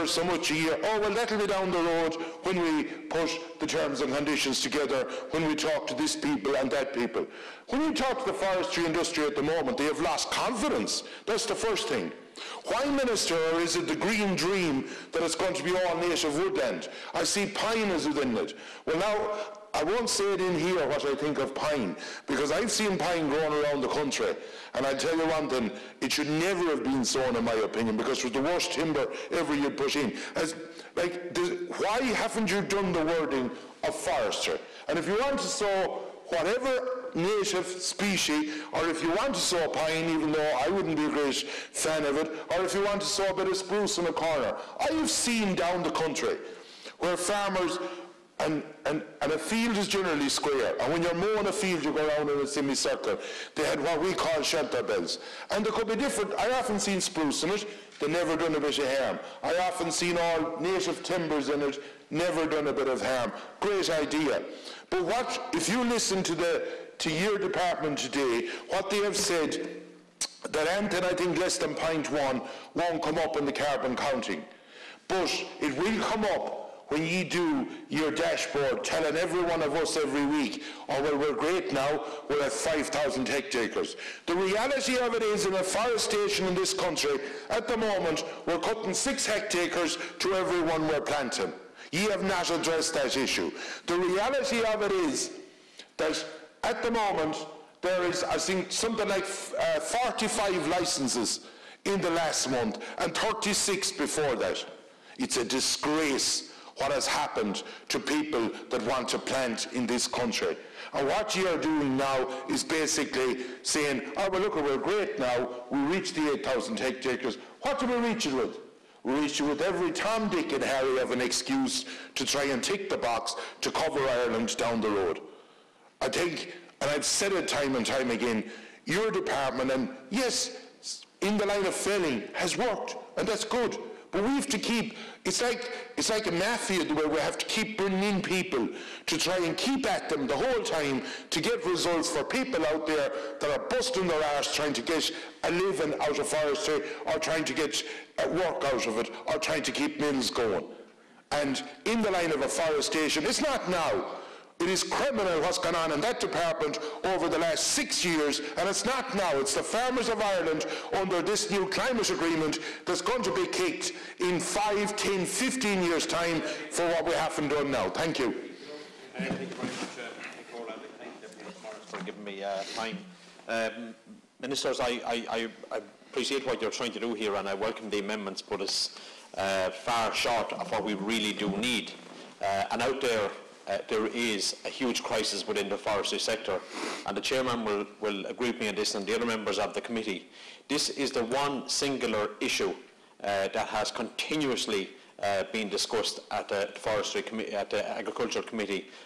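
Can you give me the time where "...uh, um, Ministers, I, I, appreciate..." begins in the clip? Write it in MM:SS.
02:53.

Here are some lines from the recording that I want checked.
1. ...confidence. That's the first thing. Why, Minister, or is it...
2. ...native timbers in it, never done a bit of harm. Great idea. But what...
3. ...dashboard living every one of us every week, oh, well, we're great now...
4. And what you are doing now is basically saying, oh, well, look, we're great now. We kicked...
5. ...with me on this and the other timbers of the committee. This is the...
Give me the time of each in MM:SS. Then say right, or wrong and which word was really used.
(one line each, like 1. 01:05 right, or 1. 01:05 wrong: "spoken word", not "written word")
1. 00:10 right
2. 01:00 right
3. 01:18 wrong: "telling", not "living"
4. 01:50 wrong: "reached", not "kicked"
5. 03:08 wrong: "members", not "timbers".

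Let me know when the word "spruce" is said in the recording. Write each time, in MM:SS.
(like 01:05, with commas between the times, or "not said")
00:43, 00:56.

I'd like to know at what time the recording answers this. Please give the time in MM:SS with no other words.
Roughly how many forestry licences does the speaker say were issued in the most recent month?
01:39.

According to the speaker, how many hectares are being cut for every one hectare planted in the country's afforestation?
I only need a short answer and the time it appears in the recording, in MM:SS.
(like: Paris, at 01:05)
6, at 01:28.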